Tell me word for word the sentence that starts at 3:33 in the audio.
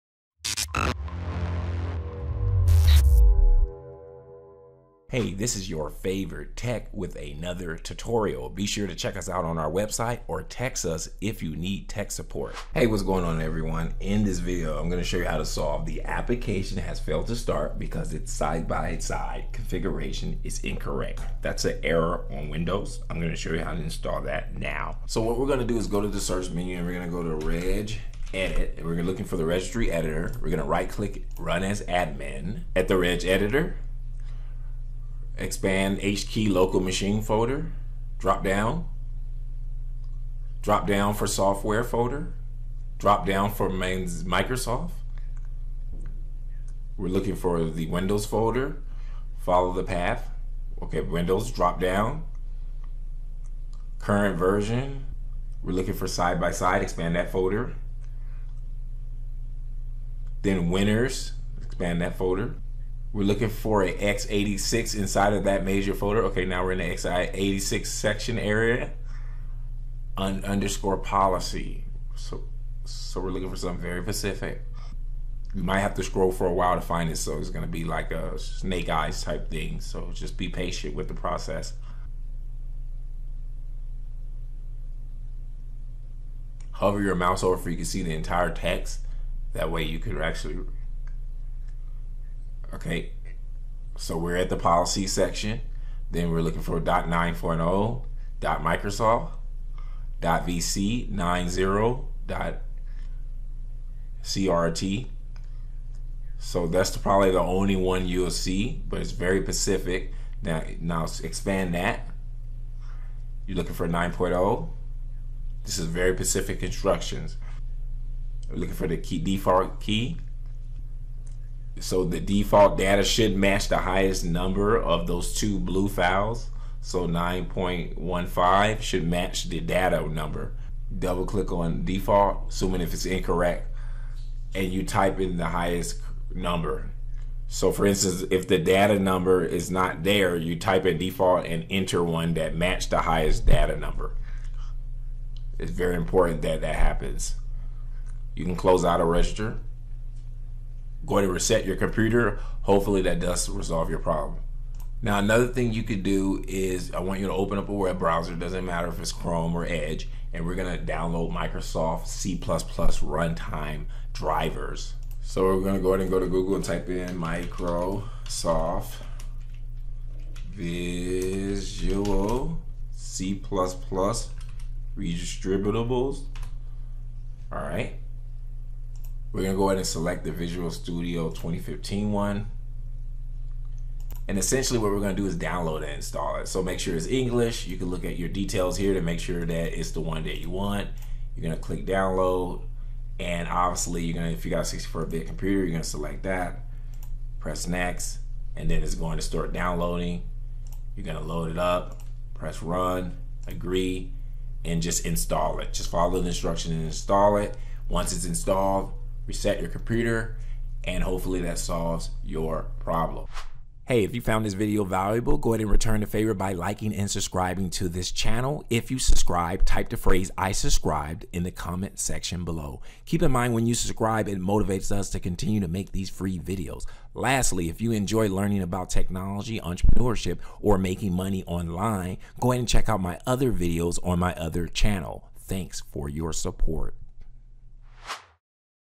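Hey, if you found this video valuable, go ahead and return the favor by liking and subscribing to this channel.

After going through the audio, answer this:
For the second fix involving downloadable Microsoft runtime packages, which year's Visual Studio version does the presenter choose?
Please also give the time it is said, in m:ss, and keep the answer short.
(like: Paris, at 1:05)
2015, at 3:00.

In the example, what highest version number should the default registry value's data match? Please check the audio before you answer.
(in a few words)
9.15.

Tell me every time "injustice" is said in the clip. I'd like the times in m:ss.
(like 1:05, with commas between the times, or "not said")
not said.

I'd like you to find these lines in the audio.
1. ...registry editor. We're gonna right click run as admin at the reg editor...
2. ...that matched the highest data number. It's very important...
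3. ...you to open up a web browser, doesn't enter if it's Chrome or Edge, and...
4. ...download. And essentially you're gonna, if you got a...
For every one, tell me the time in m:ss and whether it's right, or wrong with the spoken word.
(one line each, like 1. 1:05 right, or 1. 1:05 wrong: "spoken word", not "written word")
1. 0:29 right
2. 2:22 right
3. 2:37 wrong: "matter", not "enter"
4. 3:11 wrong: "obviously", not "essentially".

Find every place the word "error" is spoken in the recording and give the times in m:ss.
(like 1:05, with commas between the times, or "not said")
0:21.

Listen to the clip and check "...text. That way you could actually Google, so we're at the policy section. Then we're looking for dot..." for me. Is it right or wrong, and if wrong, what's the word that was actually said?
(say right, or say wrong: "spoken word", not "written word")
wrong: "Okay", not "Google".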